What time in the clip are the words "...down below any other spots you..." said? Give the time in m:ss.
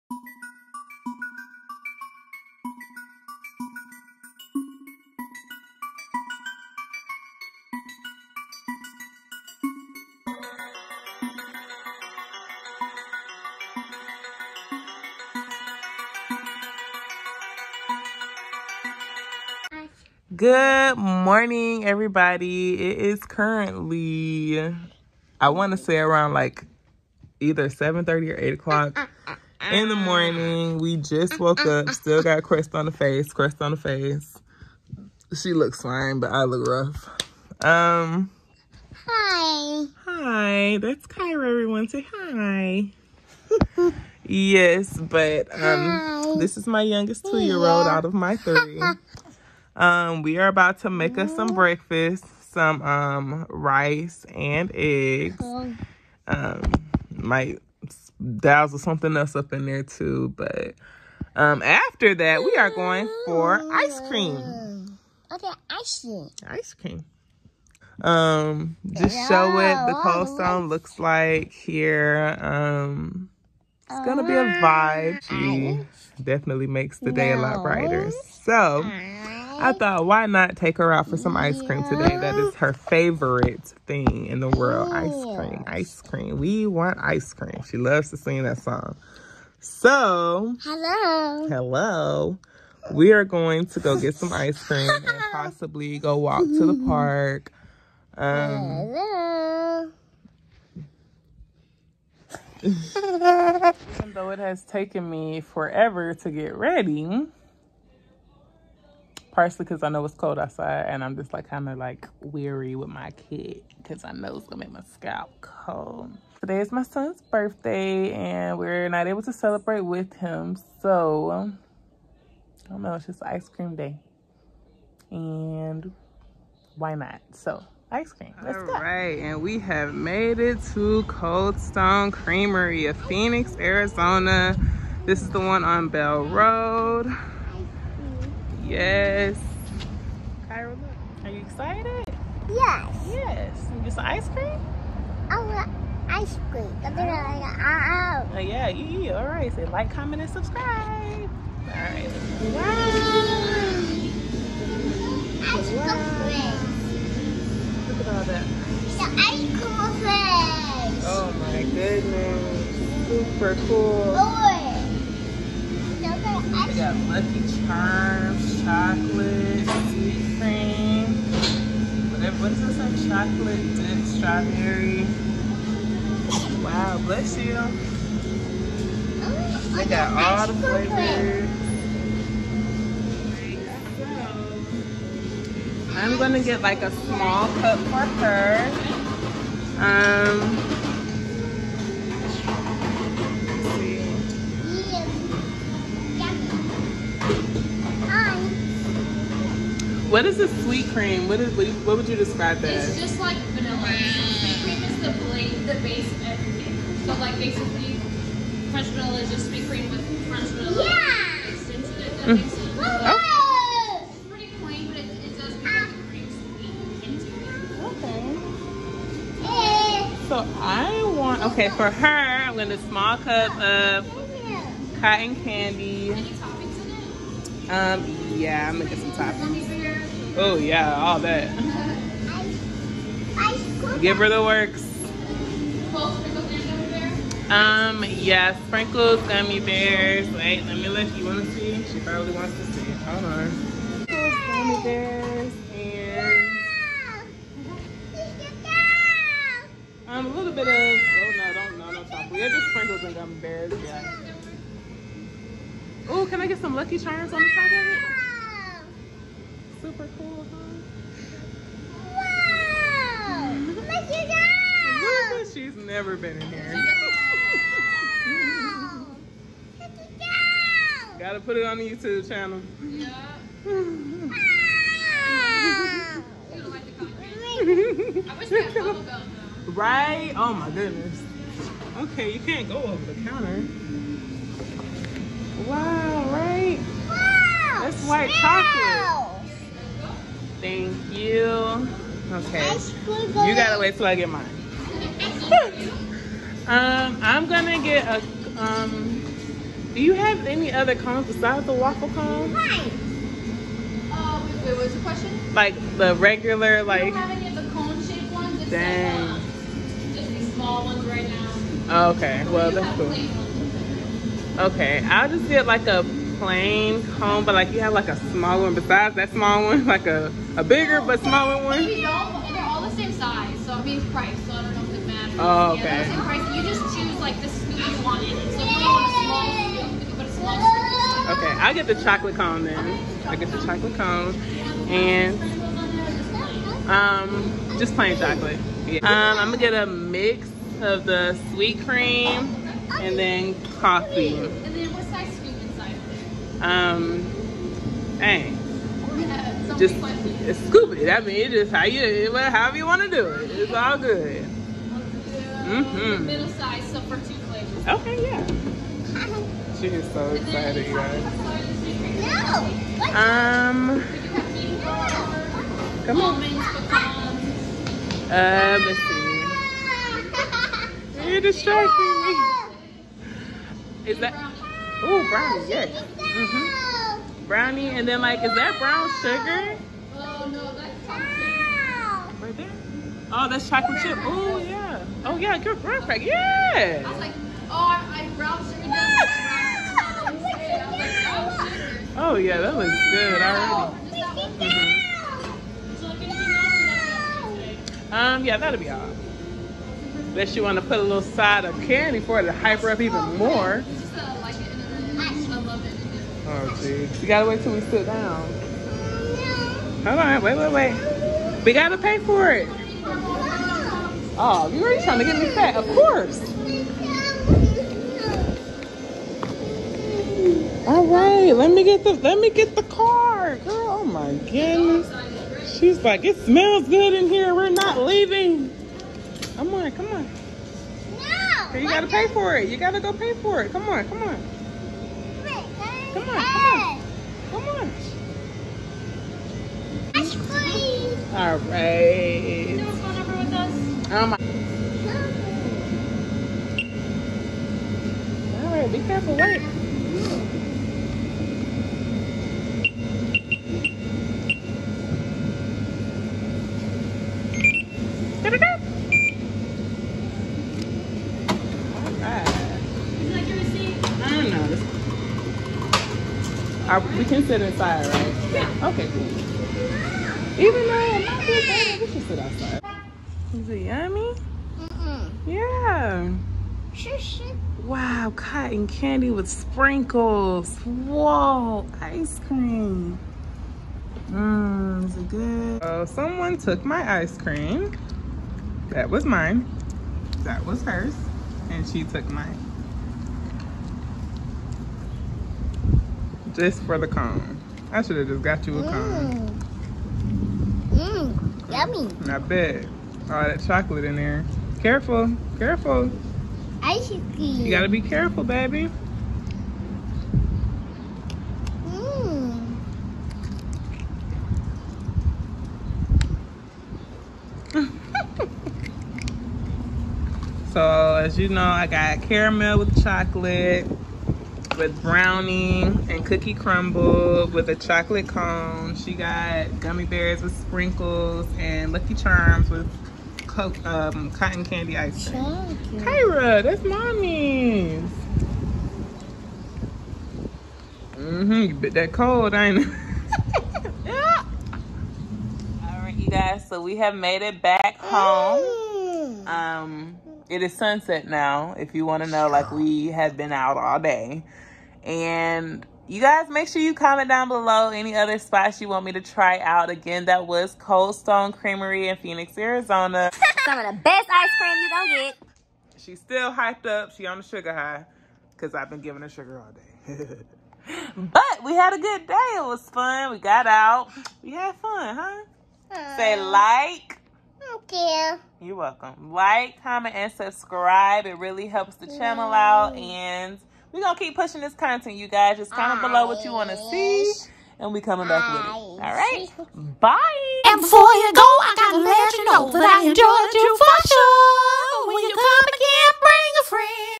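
9:17.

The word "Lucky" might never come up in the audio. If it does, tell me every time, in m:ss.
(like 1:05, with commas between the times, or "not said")
2:46, 4:16, 8:51.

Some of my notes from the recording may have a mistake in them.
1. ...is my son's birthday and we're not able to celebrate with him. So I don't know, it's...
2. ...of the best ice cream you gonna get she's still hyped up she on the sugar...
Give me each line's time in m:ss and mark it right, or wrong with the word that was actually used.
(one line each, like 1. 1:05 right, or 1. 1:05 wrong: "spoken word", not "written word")
1. 1:56 right
2. 9:23 right.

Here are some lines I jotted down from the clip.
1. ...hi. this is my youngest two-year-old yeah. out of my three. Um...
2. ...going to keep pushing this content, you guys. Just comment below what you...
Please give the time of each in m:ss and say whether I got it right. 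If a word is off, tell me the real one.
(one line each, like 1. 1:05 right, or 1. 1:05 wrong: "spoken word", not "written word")
1. 0:45 right
2. 9:44 right.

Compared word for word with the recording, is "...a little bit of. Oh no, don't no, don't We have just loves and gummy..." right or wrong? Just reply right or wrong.
wrong.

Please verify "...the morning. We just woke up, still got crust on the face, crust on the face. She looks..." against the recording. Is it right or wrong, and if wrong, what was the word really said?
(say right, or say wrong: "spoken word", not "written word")
right.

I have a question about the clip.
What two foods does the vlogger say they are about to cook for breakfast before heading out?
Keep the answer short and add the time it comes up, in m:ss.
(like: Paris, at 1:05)
rice and eggs, at 0:53.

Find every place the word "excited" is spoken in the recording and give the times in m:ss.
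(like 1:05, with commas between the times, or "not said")
2:21, 6:00.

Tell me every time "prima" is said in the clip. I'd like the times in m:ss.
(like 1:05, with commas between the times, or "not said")
not said.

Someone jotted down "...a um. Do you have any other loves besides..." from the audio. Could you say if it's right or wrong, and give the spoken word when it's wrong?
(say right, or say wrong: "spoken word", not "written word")
wrong: "cones", not "loves".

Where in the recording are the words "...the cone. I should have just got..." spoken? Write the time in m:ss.
8:16.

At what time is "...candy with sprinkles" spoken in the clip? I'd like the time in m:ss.
7:58.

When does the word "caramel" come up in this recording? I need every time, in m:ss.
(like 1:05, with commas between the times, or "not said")
8:42.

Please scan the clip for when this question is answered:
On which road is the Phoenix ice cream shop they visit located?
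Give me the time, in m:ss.
2:15.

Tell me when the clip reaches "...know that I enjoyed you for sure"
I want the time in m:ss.
9:52.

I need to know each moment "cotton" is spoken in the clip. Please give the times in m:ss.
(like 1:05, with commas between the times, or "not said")
3:44, 7:58, 8:54.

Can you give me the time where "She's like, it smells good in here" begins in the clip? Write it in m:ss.
7:05.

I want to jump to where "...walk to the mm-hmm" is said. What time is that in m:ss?
1:36.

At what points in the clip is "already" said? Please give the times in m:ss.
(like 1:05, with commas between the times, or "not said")
6:33, 6:54.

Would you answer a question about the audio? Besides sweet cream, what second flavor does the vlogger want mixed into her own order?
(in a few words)
coffee.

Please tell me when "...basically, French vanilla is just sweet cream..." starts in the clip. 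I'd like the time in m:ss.
3:27.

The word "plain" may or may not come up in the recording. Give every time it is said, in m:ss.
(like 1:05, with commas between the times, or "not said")
3:34, 5:16, 5:37.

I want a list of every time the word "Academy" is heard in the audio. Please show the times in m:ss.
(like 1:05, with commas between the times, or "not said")
not said.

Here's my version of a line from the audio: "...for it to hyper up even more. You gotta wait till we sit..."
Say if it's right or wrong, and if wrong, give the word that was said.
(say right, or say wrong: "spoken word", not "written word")
right.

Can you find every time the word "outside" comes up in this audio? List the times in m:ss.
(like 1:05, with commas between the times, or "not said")
1:50, 7:52.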